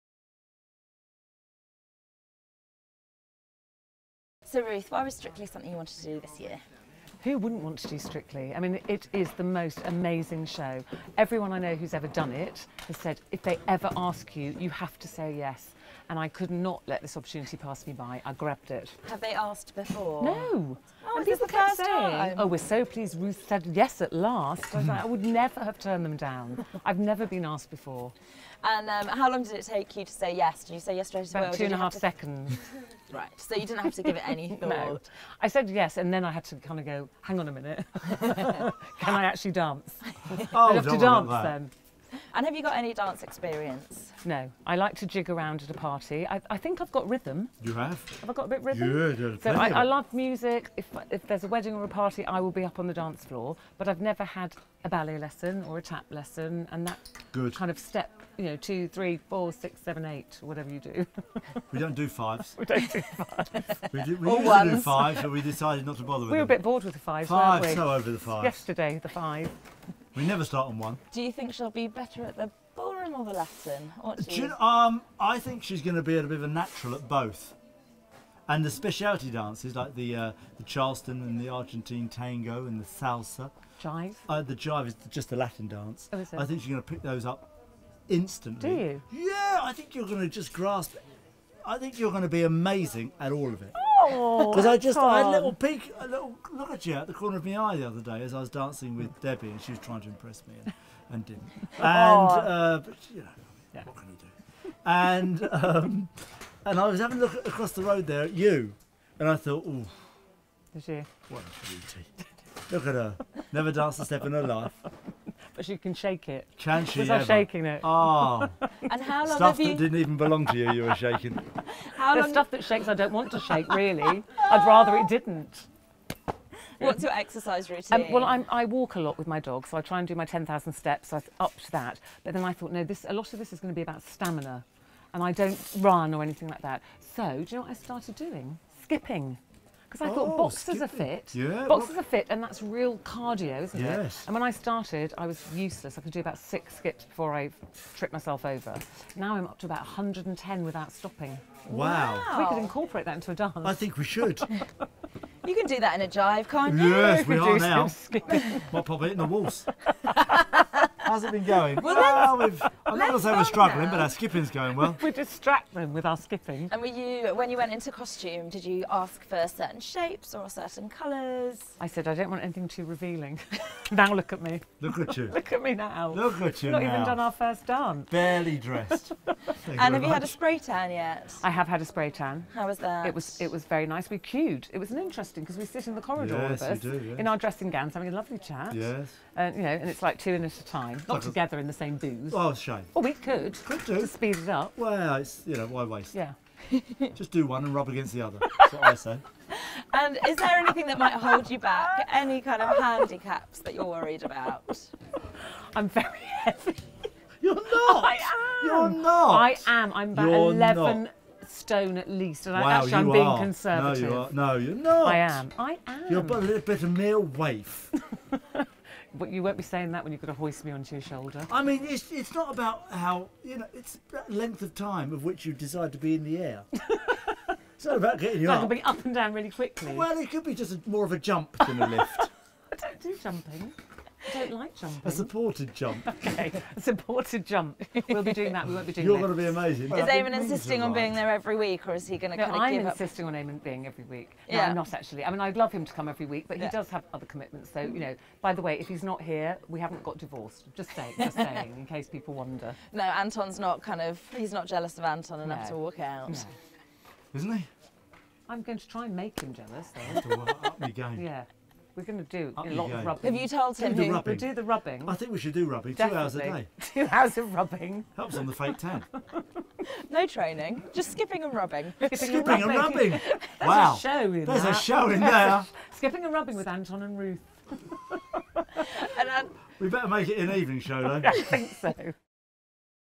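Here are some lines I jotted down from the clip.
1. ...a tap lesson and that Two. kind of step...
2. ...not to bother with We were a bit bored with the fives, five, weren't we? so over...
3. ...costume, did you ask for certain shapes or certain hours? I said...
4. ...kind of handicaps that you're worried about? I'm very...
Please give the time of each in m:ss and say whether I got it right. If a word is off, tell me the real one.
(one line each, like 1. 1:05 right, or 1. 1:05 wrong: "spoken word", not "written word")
1. 0:55 wrong: "Good", not "Two"
2. 1:05 right
3. 2:47 wrong: "colours", not "hours"
4. 3:22 right.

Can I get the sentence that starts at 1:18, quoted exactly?
And the specialty dances like the uh, the Charleston and the Argentine tango and the salsa.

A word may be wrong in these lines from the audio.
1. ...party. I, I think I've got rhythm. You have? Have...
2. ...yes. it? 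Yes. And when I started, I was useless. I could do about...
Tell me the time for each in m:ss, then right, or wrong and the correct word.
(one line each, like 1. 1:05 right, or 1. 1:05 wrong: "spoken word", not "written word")
1. 0:45 right
2. 2:23 right.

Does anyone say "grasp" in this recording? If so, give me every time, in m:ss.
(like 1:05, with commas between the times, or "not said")
1:30.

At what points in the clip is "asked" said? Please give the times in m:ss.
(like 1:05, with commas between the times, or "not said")
0:19, 0:27.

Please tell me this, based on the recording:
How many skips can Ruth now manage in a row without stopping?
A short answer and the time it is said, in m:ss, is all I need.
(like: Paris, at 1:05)
110, at 2:29.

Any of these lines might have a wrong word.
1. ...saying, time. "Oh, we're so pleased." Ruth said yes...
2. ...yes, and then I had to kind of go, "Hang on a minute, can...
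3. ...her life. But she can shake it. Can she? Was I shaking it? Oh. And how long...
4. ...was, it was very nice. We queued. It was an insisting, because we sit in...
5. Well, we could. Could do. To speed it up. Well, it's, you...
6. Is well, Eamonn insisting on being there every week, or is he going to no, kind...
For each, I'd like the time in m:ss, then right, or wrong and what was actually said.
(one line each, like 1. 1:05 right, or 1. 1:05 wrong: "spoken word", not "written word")
1. 0:21 right
2. 0:35 right
3. 1:54 right
4. 3:03 wrong: "interesting", not "insisting"
5. 3:12 right
6. 3:59 right.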